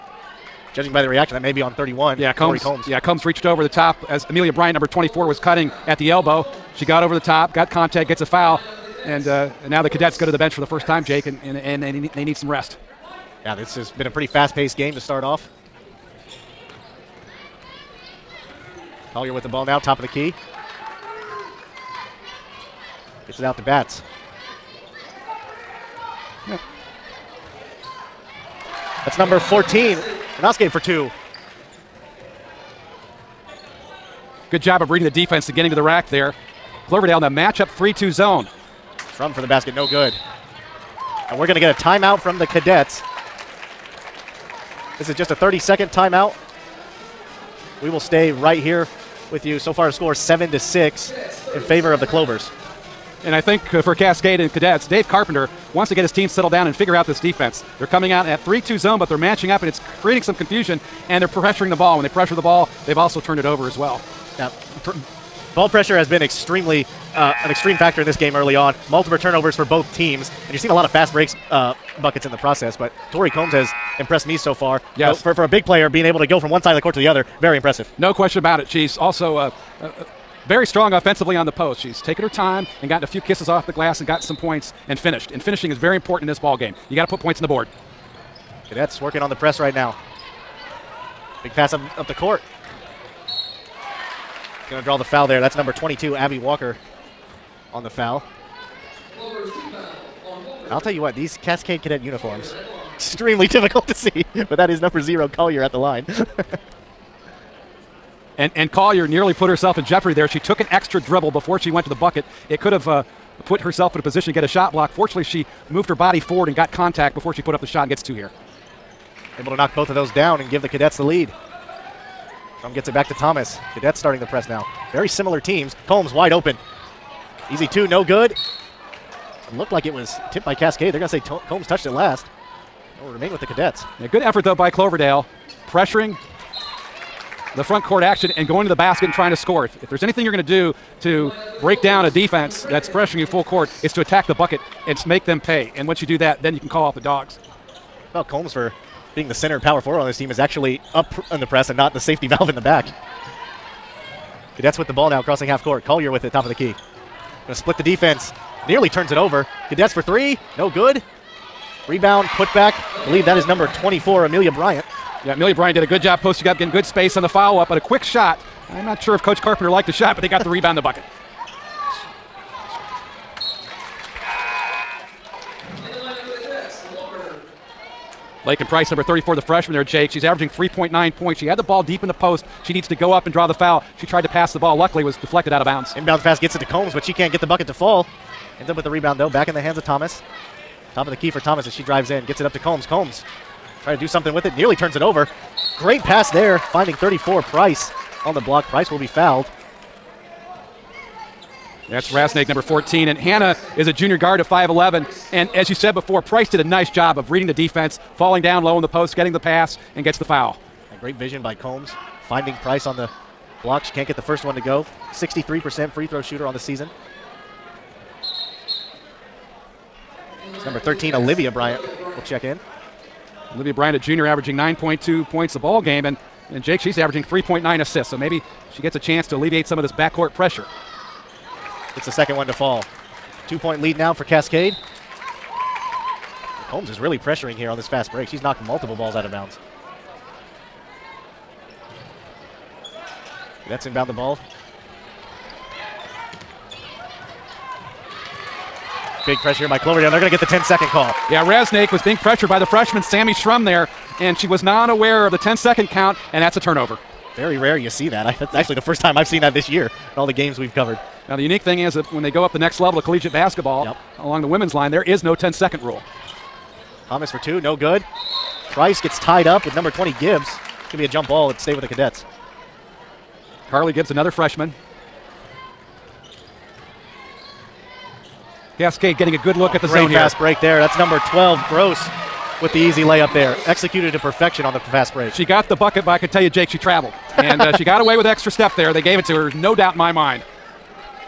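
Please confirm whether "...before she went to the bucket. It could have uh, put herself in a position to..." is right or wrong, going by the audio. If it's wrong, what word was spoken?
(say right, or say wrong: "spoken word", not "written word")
right.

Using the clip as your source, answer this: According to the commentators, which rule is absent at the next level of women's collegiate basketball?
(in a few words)
10 second rule.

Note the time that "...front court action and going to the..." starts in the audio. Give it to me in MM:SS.
02:17.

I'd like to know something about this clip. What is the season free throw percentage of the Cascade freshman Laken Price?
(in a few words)
63%.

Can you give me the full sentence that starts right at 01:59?
Able to knock both of those down and give the Cadets the lead.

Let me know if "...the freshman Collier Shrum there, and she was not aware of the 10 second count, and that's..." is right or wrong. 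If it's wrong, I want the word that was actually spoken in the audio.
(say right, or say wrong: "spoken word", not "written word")
wrong: "Sammy", not "Collier".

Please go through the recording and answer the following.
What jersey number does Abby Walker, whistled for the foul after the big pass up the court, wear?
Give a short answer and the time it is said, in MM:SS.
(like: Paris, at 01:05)
22, at 01:35.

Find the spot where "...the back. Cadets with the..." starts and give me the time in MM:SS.
02:32.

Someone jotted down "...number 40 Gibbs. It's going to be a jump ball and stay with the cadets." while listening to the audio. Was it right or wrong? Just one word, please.
wrong.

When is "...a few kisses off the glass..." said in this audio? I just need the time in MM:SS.
01:23.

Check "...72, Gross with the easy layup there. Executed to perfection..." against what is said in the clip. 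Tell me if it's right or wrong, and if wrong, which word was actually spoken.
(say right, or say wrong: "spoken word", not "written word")
wrong: "12", not "72".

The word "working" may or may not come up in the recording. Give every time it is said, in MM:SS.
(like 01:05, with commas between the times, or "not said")
01:29.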